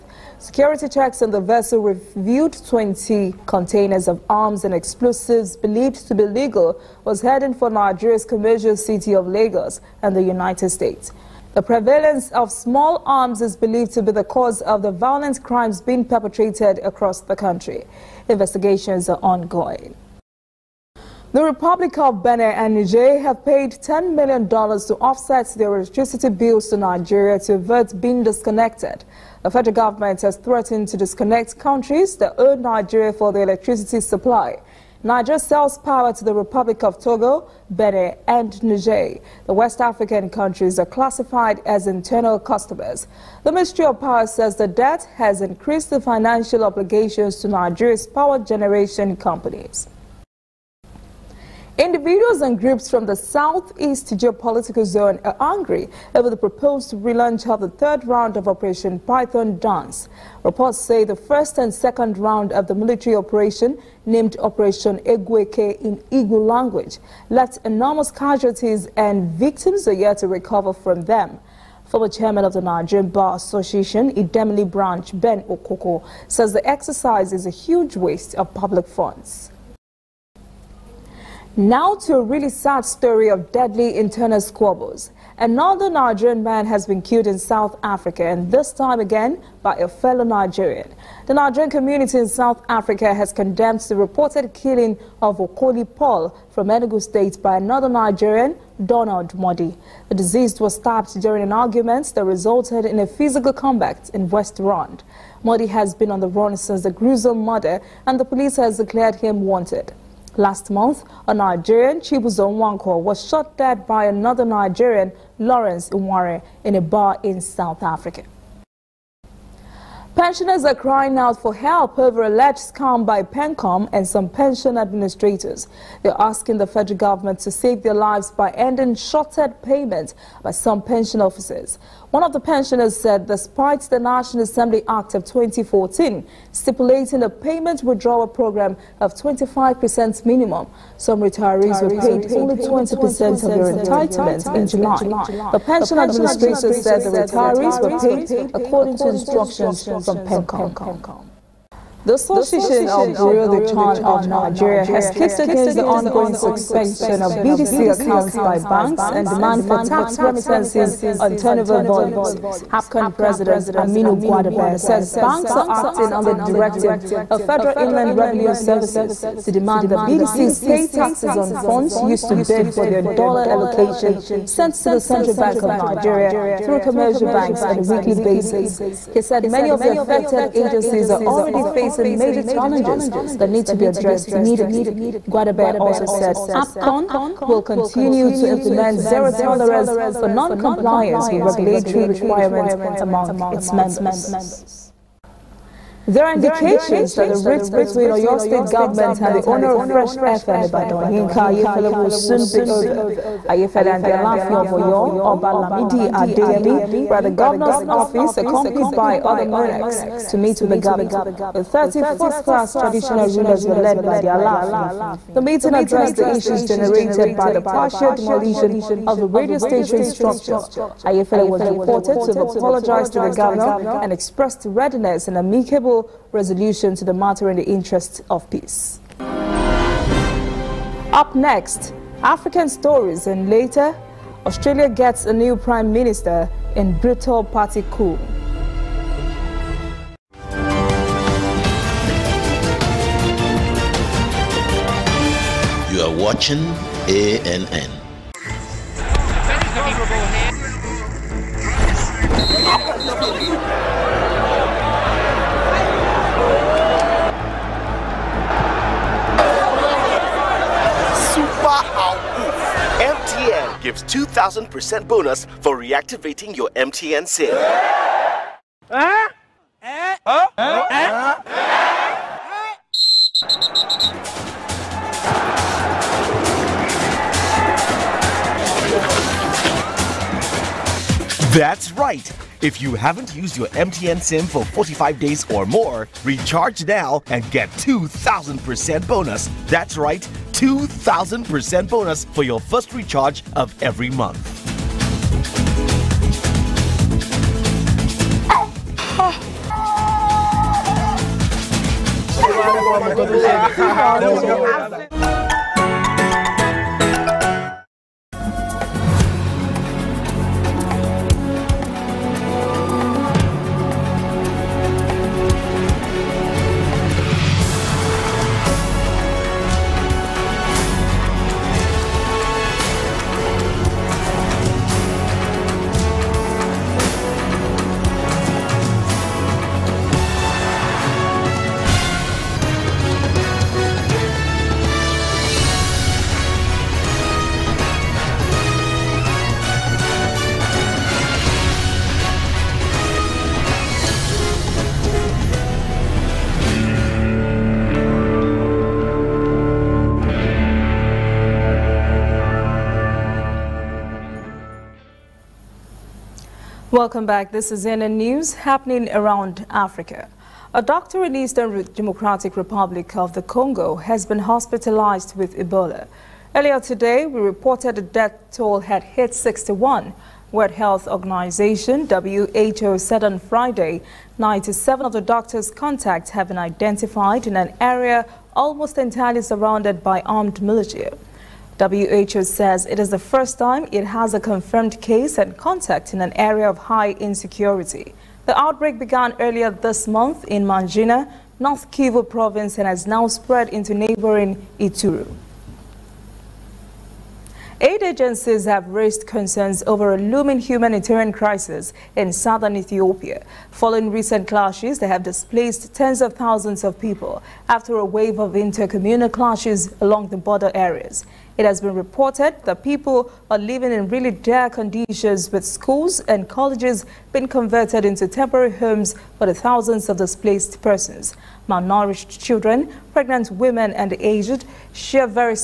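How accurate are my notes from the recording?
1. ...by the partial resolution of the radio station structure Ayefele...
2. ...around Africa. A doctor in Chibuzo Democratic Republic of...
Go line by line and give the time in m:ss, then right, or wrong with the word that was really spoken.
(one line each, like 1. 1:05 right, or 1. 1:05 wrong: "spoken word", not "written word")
1. 3:37 wrong: "demolition", not "resolution"
2. 5:59 wrong: "Eastern", not "Chibuzo".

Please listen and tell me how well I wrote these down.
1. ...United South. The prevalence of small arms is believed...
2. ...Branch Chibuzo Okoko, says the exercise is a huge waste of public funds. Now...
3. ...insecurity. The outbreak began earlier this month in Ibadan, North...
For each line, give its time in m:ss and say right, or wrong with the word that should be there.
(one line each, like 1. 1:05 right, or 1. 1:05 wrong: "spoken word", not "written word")
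1. 0:10 wrong: "States", not "South"
2. 1:14 wrong: "Ben", not "Chibuzo"
3. 6:27 wrong: "Mangina", not "Ibadan".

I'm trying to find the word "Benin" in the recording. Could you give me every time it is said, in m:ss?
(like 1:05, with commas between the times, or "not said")
0:22, 0:37.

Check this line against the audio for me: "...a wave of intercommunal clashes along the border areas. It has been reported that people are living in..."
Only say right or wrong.
right.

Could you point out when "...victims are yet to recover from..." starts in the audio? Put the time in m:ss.
1:09.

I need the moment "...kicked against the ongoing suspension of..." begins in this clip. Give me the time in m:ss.
2:35.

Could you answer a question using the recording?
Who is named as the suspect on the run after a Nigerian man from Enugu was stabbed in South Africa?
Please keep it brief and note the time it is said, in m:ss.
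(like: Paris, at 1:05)
Donald Modi, at 1:38.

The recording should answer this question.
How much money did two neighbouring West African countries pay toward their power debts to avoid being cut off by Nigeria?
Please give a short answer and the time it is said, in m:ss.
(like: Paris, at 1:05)
$10 million, at 0:23.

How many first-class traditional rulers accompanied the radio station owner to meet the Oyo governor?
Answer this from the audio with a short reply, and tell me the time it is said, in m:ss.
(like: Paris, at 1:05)
30, at 3:31.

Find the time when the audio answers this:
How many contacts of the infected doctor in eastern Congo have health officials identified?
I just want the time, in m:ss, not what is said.
6:14.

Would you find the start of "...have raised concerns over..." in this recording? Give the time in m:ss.
6:38.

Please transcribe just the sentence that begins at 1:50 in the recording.
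Last month, a Nigerian, Chibuzo Nwanko, was shot dead by another Nigerian, Lawrence Iware, in a bar in South Africa.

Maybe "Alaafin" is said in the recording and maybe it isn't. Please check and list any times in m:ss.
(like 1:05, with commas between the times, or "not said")
3:24, 3:34.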